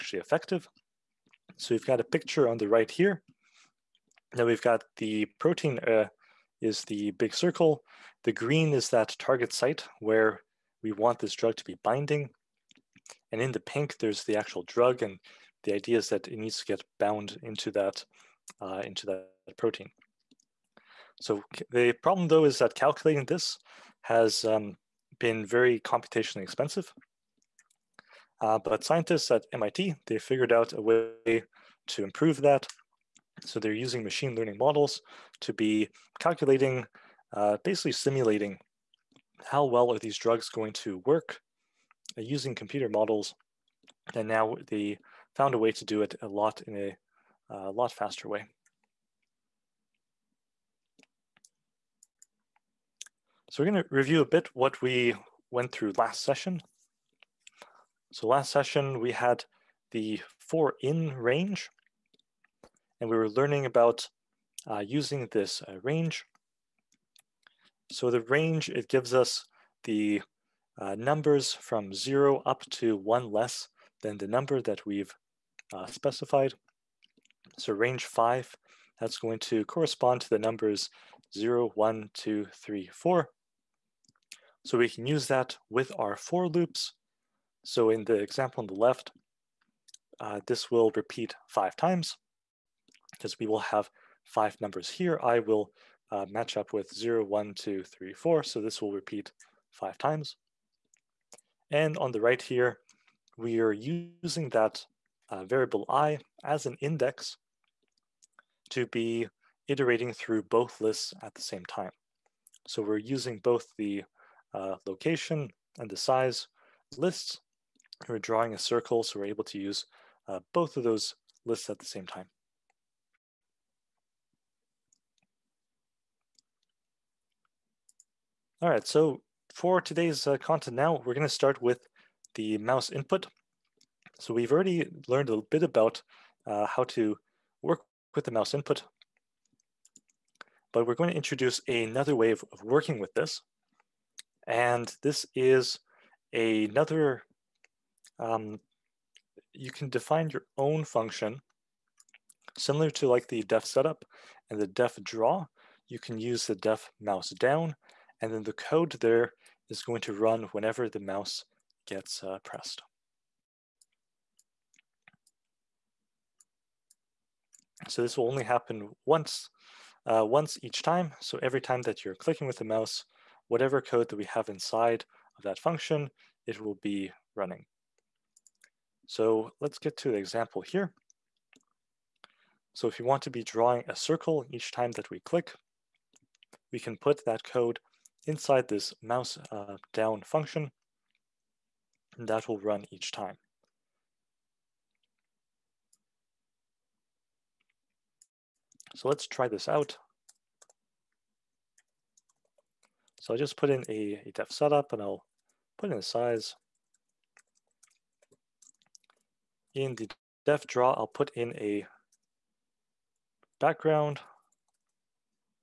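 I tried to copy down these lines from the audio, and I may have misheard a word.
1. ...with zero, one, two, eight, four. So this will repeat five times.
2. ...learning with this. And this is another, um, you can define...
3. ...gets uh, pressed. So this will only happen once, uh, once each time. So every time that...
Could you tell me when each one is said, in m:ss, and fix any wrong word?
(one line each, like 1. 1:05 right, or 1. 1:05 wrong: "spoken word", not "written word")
1. 1:36 wrong: "three", not "eight"
2. 2:22 wrong: "working", not "learning"
3. 2:41 right.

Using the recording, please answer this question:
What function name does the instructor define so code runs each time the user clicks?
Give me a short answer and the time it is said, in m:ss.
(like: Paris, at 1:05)
mouse down, at 2:36.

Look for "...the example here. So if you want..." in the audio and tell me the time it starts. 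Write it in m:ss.
3:00.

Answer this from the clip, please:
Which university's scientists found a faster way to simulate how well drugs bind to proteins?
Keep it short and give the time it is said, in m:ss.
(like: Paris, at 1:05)
MIT, at 0:29.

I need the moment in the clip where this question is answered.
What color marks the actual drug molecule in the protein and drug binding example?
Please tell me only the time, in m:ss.
0:13.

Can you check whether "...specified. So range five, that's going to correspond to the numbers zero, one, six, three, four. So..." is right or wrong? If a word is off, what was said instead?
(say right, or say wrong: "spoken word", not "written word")
wrong: "two", not "six".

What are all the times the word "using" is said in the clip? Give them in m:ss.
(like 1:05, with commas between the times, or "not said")
0:33, 0:42, 1:04, 1:43, 1:52.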